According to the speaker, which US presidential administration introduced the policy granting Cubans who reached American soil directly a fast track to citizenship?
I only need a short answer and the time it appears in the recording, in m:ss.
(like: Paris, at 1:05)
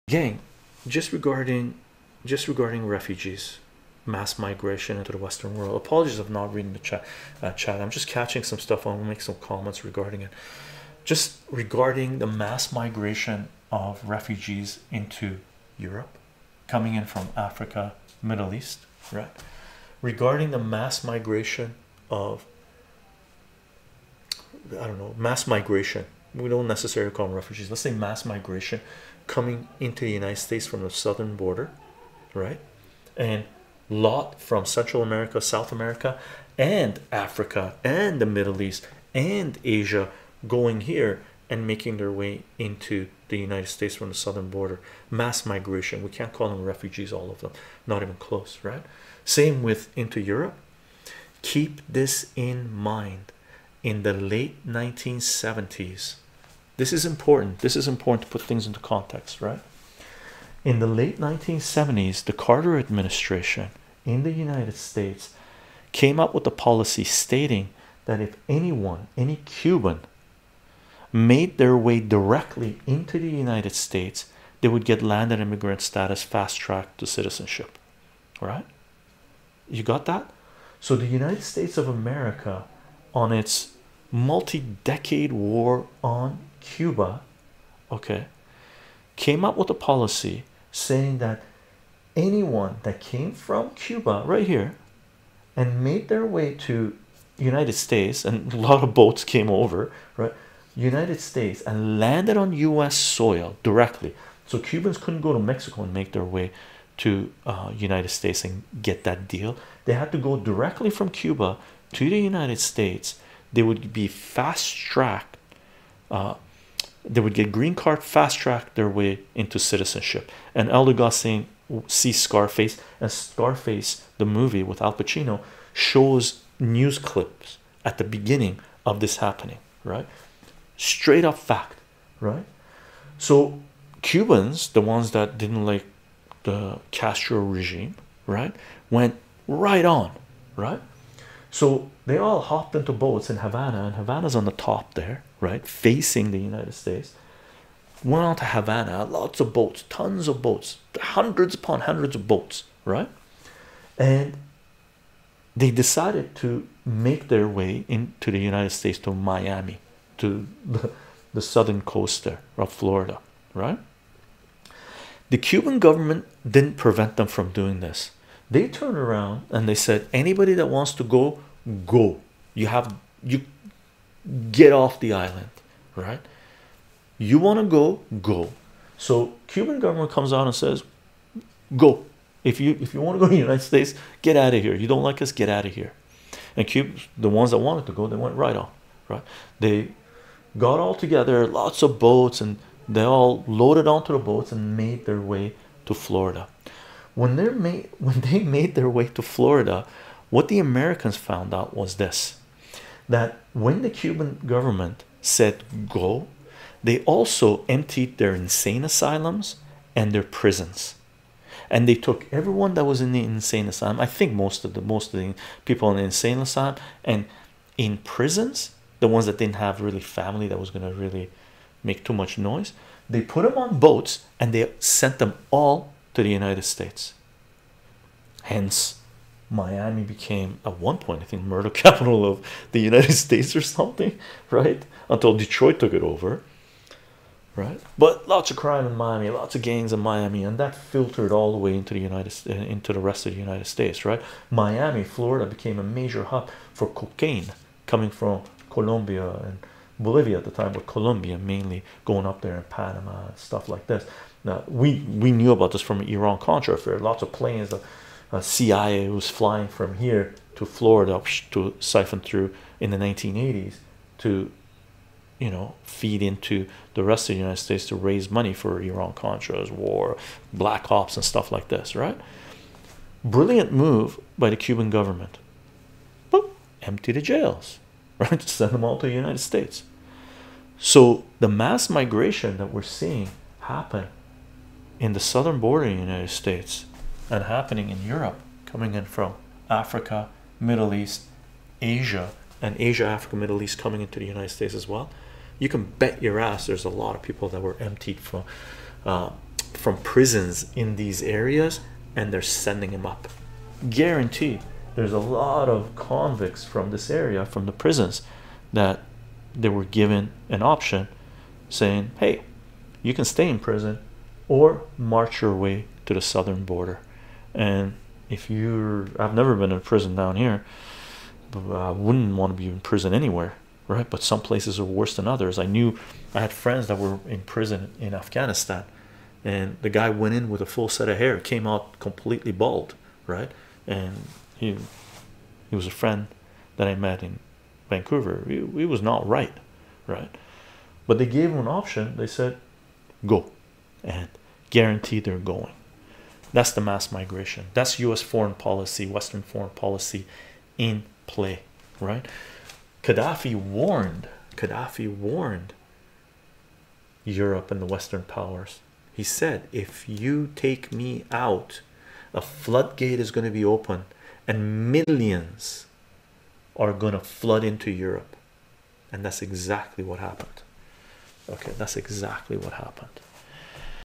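Carter administration, at 1:02.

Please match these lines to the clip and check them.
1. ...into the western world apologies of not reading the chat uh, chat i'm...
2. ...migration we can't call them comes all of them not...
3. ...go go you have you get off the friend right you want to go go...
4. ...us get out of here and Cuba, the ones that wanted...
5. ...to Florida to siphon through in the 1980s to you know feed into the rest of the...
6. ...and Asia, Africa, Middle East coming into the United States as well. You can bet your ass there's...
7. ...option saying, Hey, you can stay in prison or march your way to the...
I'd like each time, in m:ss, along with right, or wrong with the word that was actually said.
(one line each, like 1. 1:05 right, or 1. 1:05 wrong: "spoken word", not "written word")
1. 0:04 right
2. 0:45 wrong: "refugees", not "comes"
3. 2:51 wrong: "island", not "friend"
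4. 3:05 right
5. 4:20 right
6. 4:52 right
7. 5:10 right.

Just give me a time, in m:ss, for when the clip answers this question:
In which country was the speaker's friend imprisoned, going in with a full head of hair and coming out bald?
5:28.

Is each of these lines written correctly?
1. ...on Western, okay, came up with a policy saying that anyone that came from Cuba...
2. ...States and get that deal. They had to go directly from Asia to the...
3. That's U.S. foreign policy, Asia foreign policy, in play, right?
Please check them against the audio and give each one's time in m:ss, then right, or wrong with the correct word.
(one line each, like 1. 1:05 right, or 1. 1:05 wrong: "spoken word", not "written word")
1. 1:26 wrong: "Cuba", not "Western"
2. 1:48 wrong: "Cuba", not "Asia"
3. 5:47 wrong: "Western", not "Asia".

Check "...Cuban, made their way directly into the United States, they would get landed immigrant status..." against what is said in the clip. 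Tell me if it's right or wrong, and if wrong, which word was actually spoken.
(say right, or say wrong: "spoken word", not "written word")
right.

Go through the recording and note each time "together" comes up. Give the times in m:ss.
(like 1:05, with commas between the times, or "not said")
3:11.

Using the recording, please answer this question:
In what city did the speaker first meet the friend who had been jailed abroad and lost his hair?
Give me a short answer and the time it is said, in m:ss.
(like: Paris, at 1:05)
Vancouver, at 5:37.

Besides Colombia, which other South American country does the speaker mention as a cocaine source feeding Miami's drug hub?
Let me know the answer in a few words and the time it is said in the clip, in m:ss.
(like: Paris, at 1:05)
Bolivia, at 4:10.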